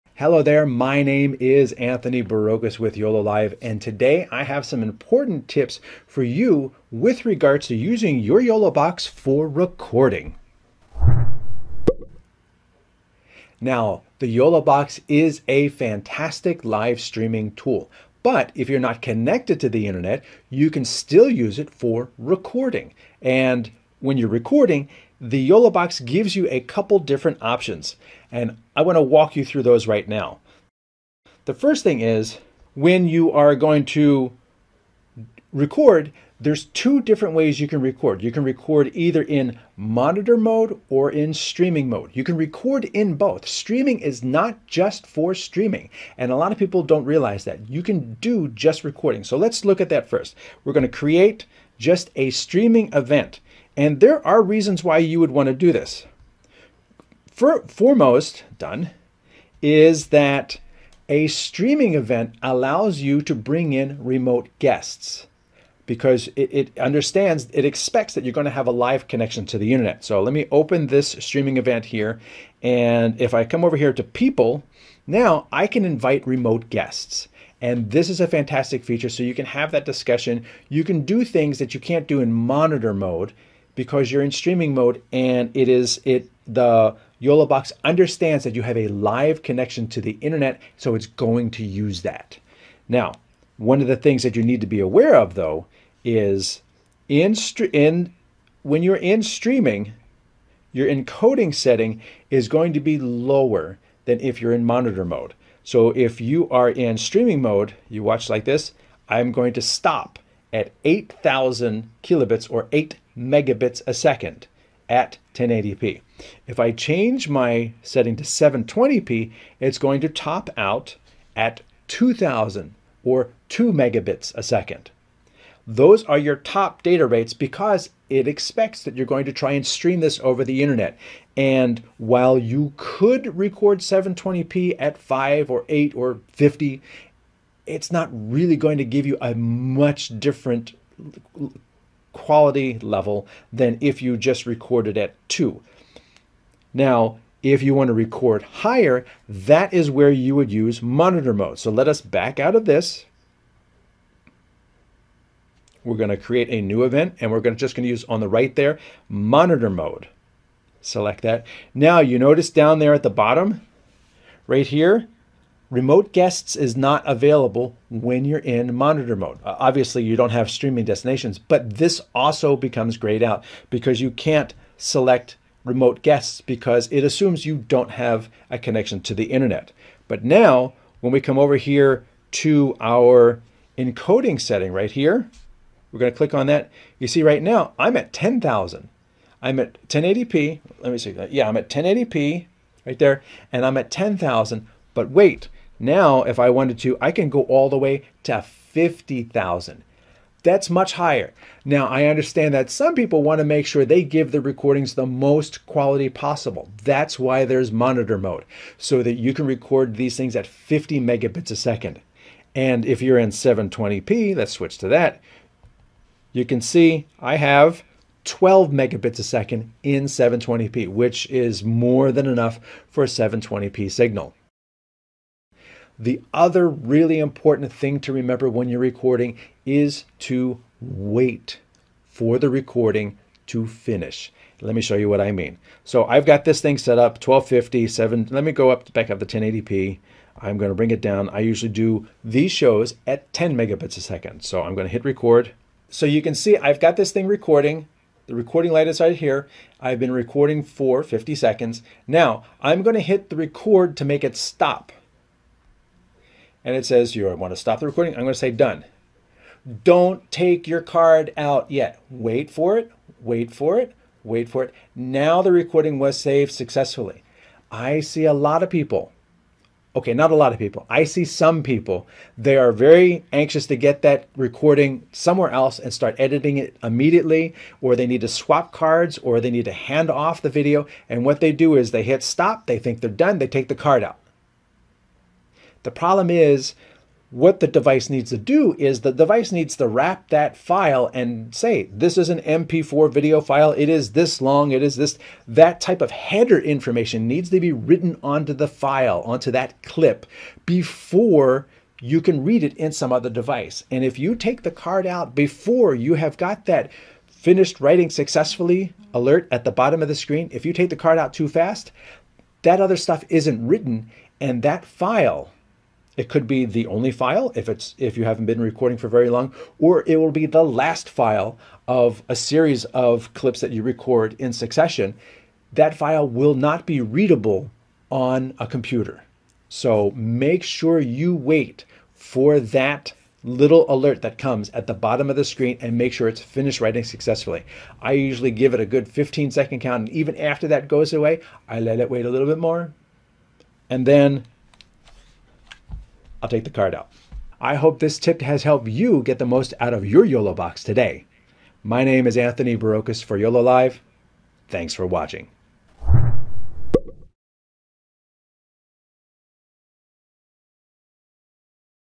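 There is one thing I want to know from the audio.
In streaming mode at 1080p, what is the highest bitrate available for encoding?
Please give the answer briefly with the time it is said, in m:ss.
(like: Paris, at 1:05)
8,000 kilobits per second, at 1:50.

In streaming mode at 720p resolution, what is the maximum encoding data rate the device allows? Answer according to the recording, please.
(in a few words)
2,000 kilobits per second.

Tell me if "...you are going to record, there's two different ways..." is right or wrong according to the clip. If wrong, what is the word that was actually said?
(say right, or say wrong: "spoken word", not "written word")
right.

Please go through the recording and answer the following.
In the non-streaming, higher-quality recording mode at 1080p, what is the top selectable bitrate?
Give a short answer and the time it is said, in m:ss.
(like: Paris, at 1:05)
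50,000, at 3:18.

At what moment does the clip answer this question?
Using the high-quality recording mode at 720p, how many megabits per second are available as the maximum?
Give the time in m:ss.
3:38.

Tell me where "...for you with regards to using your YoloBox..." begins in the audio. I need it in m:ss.
0:06.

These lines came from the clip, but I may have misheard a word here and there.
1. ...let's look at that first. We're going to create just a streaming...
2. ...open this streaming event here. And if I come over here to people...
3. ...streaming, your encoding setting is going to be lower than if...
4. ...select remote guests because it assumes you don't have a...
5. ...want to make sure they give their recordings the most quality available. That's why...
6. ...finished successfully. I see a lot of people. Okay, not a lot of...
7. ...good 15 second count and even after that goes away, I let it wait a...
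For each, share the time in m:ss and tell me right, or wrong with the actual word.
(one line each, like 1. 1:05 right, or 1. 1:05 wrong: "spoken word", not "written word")
1. 0:49 right
2. 1:10 right
3. 1:39 right
4. 2:54 right
5. 3:23 wrong: "possible", not "available"
6. 4:26 wrong: "saved", not "finished"
7. 5:38 right.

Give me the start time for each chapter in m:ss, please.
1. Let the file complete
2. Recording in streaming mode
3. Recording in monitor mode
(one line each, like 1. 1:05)
1. 3:46
2. 0:32
3. 2:33.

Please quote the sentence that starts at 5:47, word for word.
I hope this tip has helped you get the most out of your YoloBox today.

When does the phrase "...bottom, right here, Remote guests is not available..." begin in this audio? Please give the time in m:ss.
2:43.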